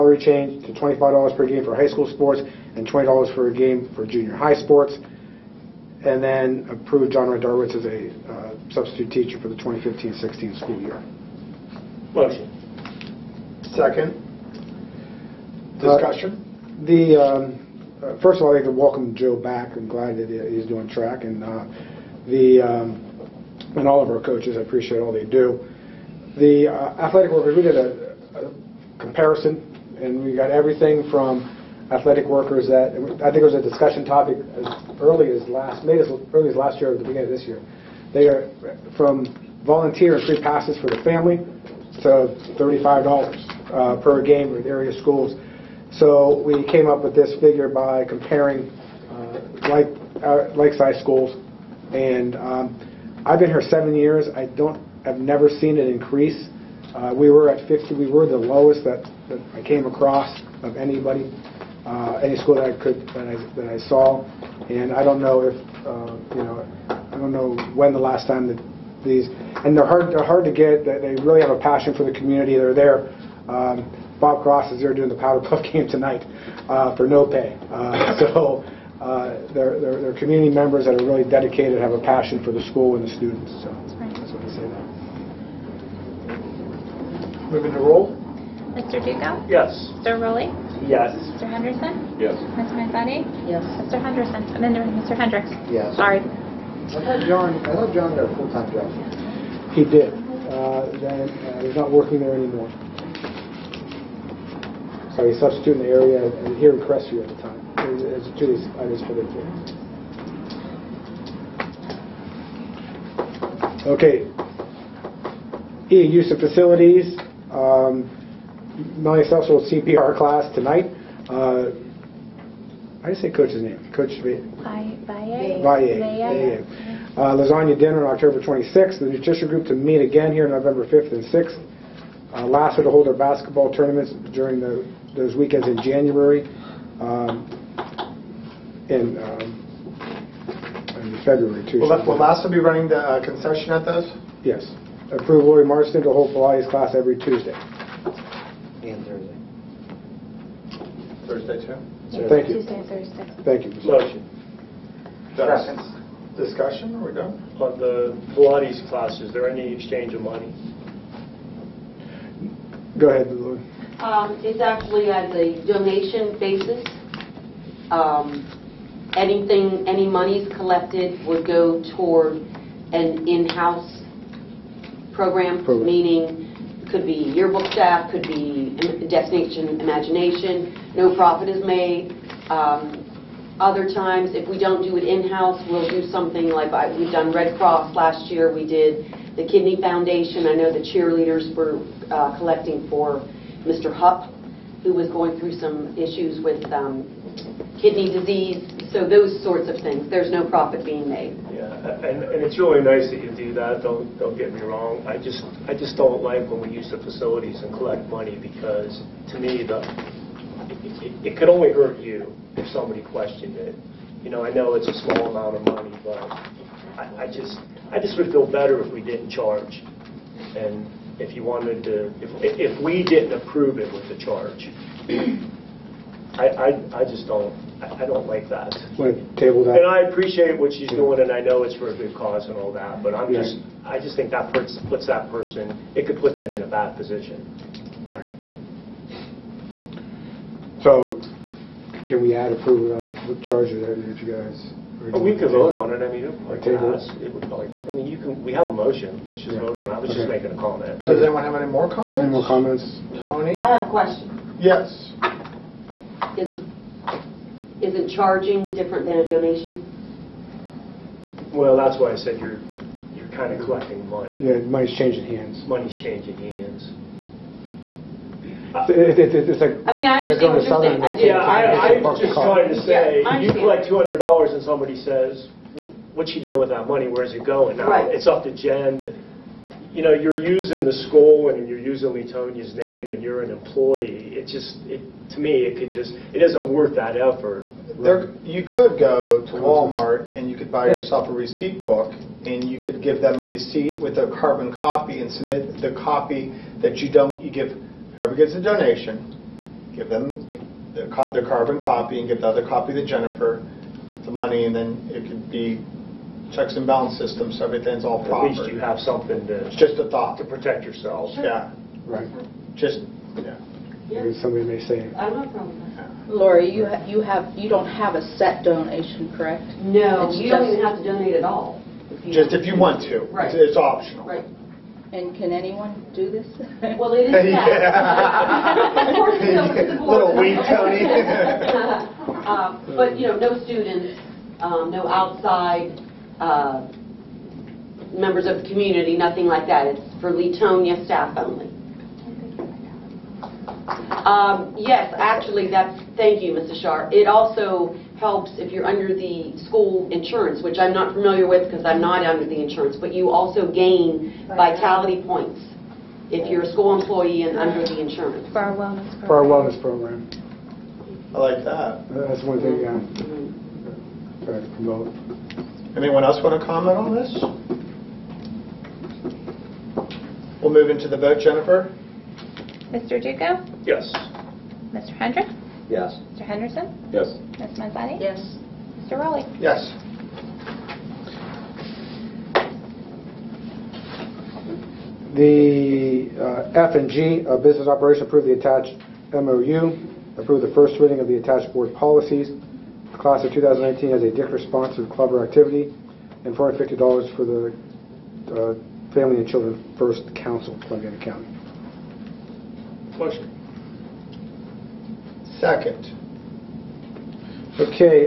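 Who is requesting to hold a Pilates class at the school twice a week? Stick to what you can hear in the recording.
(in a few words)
Lori Marston.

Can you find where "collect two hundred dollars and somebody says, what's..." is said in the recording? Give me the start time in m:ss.
4:33.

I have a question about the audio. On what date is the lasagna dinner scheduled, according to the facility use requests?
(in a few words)
October 26.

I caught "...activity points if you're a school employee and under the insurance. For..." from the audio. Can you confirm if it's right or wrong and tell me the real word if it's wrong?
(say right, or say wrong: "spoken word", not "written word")
wrong: "vitality", not "activity".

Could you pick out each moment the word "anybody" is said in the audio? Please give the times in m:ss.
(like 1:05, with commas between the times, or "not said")
1:00.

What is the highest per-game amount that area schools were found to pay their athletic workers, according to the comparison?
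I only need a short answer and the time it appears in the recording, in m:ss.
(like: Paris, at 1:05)
$35, at 0:42.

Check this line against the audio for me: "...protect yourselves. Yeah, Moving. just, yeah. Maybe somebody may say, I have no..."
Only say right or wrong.
wrong.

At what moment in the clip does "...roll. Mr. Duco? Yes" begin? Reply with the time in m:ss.
1:27.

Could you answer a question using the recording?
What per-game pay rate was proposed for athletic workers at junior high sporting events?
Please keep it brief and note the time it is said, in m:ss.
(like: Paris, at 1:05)
$20, at 0:02.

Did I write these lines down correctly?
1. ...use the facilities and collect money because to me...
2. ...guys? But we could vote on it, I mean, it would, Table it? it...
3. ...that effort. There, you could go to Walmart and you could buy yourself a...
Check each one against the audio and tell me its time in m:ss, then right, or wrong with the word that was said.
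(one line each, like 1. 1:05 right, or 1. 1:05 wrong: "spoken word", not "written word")
1. 3:26 right
2. 4:04 right
3. 4:46 right.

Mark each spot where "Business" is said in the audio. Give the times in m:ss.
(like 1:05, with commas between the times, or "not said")
6:27.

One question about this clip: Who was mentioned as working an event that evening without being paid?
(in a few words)
Bob Cross.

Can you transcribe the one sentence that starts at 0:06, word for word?
And then approve John Rodarowitz as a uh, substitute teacher for the 2015-16 school year.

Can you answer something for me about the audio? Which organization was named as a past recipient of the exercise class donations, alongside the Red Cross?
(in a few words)
Kidney Foundation.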